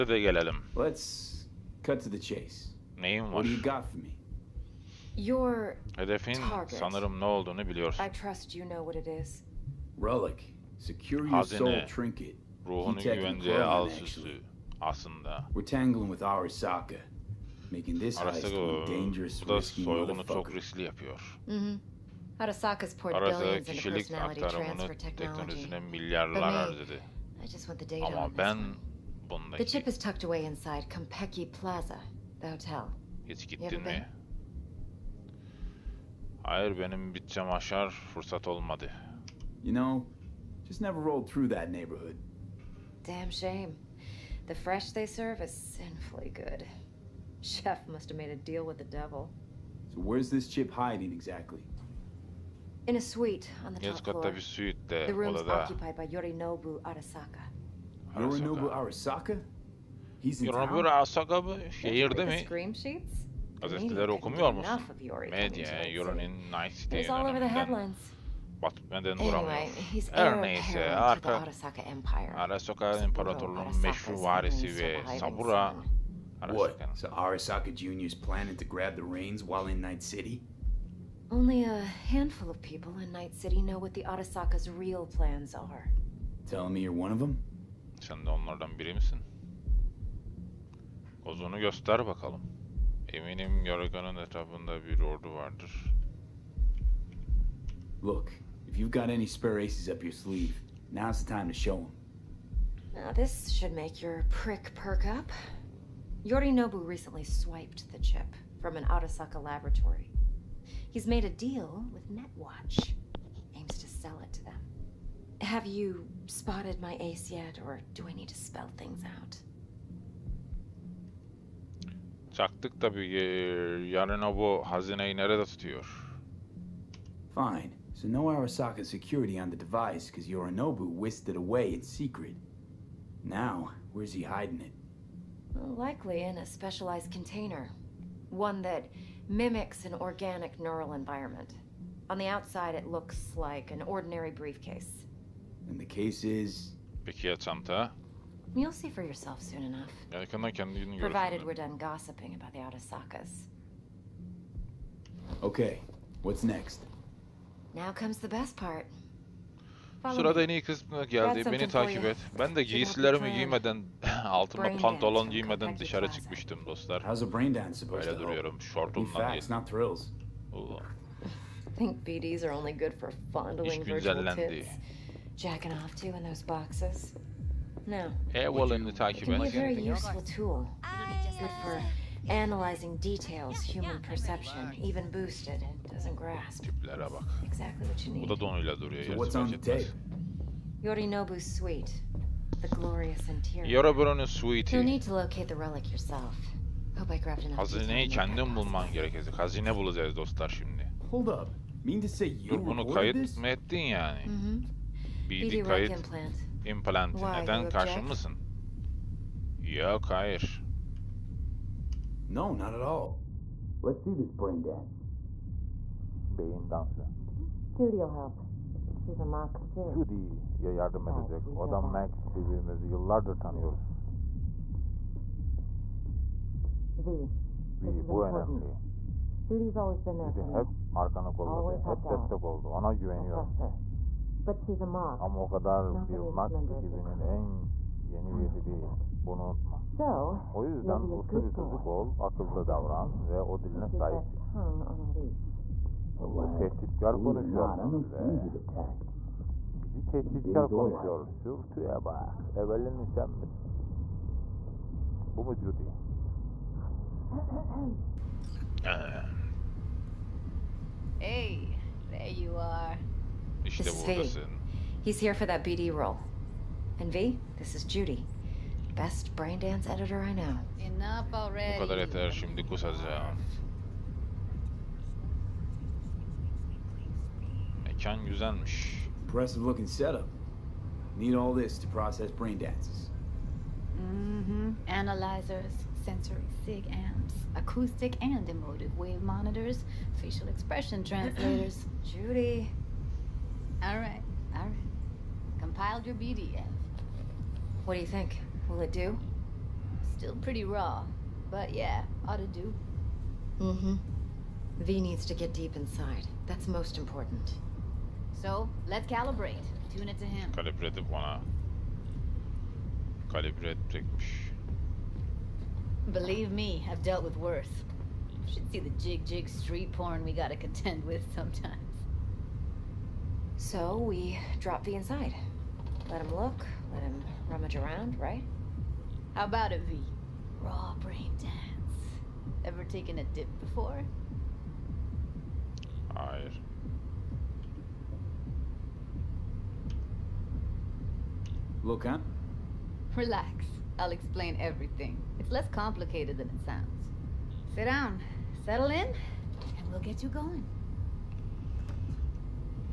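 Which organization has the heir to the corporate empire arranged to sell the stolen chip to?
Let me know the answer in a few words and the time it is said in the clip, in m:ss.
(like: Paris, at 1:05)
Netwatch, at 1:52.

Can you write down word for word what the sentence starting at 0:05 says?
Your Hedefin sanırım ne olduğunu biliyorsun.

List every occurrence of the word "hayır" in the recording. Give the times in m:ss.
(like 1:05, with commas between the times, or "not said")
0:36, 3:30.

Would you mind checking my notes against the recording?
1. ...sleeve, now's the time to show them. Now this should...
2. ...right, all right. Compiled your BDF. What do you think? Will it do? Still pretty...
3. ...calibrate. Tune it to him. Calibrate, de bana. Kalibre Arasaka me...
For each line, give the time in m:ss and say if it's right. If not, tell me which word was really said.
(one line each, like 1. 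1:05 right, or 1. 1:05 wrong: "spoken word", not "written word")
1. 1:40 right
2. 4:53 right
3. 5:09 wrong: "Believe", not "Arasaka".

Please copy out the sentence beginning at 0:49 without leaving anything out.
So where's this chip hiding exactly?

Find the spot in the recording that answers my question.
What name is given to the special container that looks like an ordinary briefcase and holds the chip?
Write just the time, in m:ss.
2:27.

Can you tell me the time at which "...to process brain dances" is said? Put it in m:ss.
4:41.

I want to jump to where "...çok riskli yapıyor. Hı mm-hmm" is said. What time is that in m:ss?
0:20.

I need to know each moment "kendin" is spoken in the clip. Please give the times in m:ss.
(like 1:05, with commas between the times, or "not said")
3:18.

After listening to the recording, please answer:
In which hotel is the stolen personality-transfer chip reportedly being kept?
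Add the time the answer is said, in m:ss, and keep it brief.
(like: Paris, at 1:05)
Kompeki Plaza, at 0:30.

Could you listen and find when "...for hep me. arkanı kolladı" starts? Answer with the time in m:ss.
3:50.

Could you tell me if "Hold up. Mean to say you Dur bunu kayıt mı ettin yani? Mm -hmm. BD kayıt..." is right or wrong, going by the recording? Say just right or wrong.
right.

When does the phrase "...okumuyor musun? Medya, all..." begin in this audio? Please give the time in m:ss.
1:04.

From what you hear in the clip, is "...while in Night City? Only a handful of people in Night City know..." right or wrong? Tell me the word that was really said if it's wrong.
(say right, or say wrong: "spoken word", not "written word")
right.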